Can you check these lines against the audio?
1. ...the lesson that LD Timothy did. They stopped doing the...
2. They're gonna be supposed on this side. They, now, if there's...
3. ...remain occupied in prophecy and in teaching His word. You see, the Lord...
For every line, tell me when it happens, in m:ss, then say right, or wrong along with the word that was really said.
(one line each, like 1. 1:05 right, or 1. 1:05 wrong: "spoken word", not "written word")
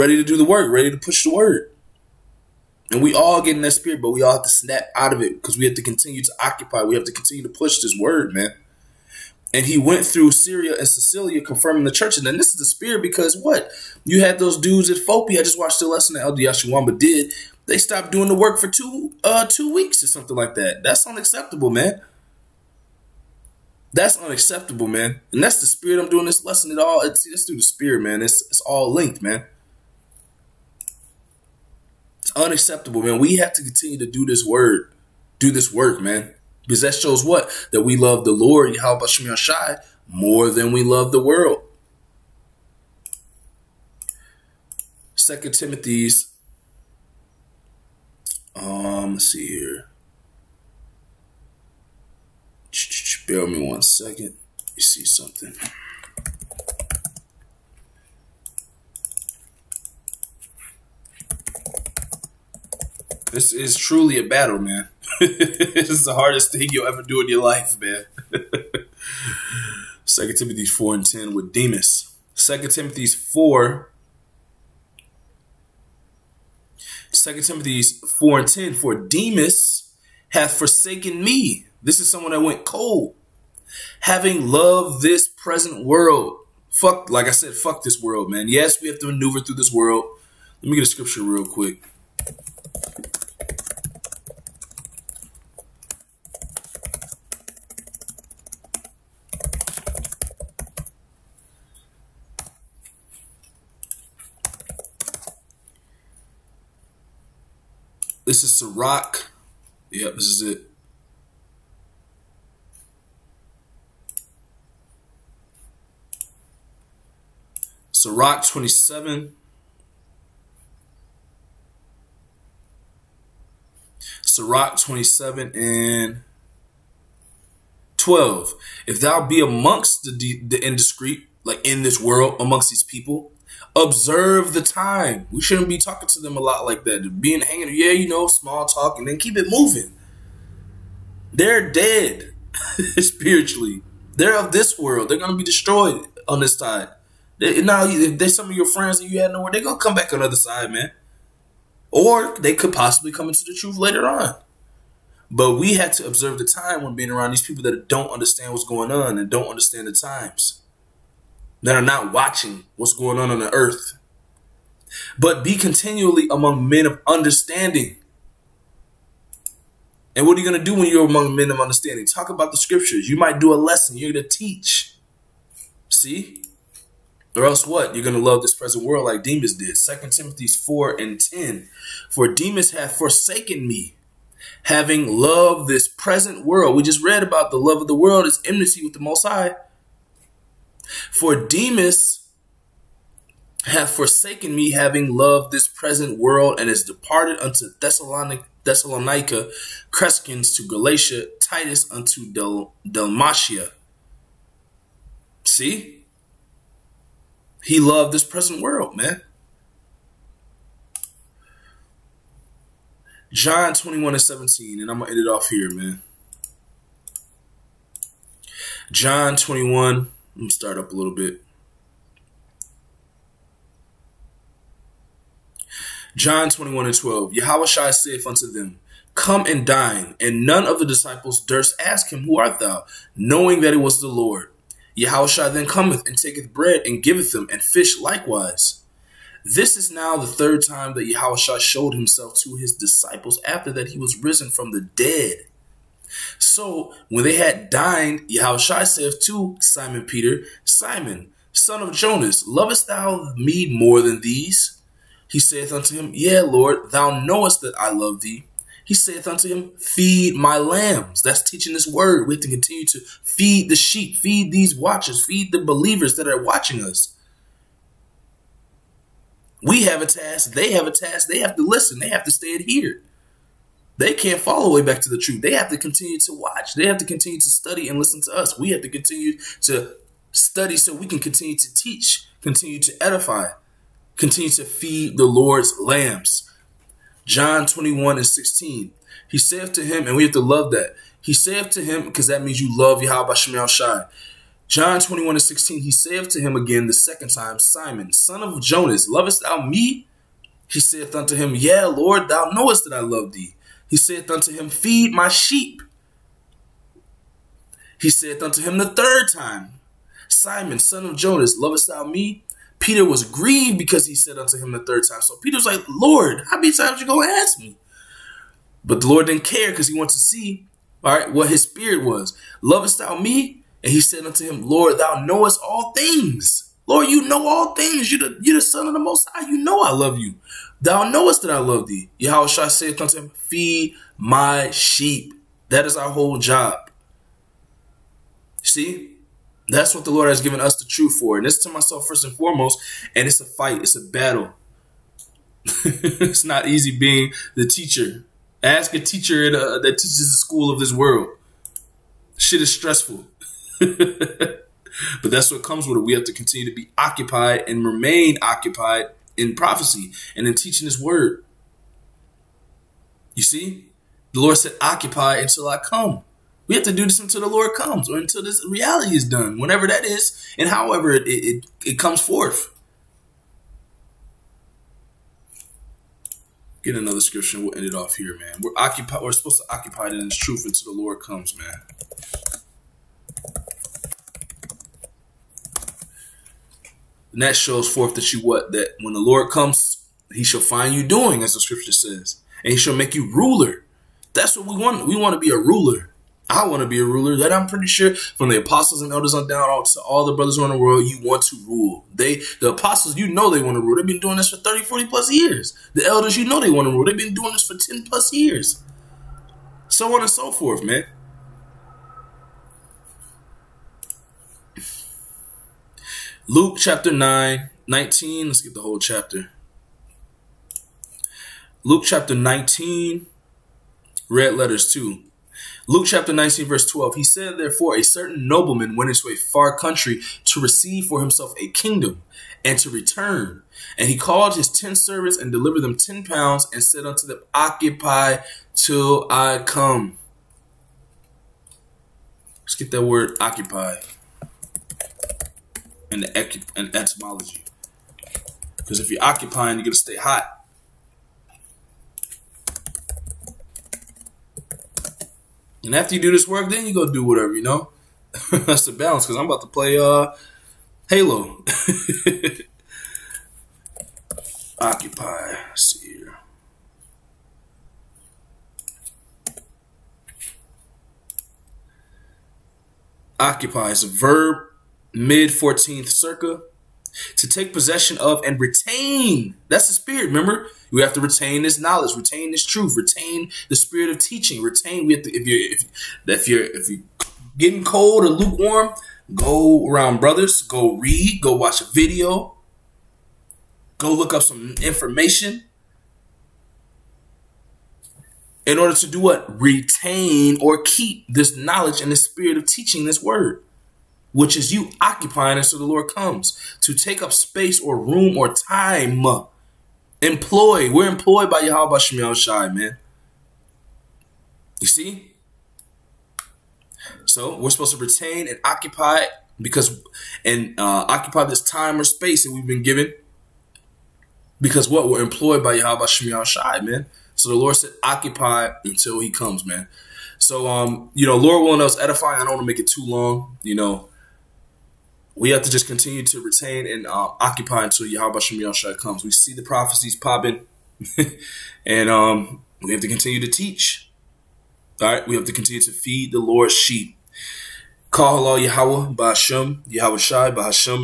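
1. 0:15 wrong: "Yashuamba", not "Timothy"
2. 2:25 wrong: "destroyed", not "supposed"
3. 5:57 right.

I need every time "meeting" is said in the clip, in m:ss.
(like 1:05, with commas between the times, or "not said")
not said.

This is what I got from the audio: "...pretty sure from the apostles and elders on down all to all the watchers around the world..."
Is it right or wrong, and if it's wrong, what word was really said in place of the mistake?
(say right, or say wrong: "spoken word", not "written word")
wrong: "brothers", not "watchers".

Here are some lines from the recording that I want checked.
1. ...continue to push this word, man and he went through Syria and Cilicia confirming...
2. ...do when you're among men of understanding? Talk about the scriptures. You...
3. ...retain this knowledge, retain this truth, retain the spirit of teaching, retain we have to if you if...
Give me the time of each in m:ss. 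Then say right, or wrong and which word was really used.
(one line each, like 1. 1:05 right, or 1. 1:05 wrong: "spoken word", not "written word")
1. 0:07 right
2. 2:50 right
3. 8:01 right.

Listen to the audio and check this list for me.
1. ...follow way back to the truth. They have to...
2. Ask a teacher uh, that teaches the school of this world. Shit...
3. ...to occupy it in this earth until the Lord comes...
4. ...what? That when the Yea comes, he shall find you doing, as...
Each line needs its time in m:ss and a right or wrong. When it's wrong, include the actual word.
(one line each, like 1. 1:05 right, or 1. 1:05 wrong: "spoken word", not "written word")
1. 4:34 right
2. 5:48 right
3. 6:19 wrong: "truth", not "earth"
4. 6:28 wrong: "Lord", not "Yea".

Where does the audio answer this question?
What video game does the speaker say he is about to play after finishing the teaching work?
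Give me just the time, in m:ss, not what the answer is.
7:41.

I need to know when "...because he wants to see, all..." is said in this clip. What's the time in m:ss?
5:19.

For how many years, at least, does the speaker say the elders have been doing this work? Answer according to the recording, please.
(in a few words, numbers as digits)
10.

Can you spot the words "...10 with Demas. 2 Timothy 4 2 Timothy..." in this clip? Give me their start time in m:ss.
1:11.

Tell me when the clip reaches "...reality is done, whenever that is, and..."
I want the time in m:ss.
6:08.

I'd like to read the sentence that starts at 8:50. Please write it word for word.
So, um, you know, Lord willing, us edify.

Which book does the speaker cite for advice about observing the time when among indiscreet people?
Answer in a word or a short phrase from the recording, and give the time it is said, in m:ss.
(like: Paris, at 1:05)
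Sirach 27:12, at 1:57.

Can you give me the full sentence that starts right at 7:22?
Let's get that word occupy and the etymology.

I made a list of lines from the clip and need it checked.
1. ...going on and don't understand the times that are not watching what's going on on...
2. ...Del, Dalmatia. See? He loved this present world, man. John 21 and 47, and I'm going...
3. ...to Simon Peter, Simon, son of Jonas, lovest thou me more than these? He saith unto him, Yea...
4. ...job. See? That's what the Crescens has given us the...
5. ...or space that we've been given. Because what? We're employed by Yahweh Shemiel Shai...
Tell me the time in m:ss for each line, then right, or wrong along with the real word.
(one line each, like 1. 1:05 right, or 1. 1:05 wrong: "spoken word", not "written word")
1. 2:38 right
2. 3:22 wrong: "17", not "47"
3. 4:09 right
4. 5:36 wrong: "Lord", not "Crescens"
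5. 8:42 right.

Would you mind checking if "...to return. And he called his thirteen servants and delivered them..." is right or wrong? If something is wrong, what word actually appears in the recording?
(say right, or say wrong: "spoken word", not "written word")
wrong: "ten", not "thirteen".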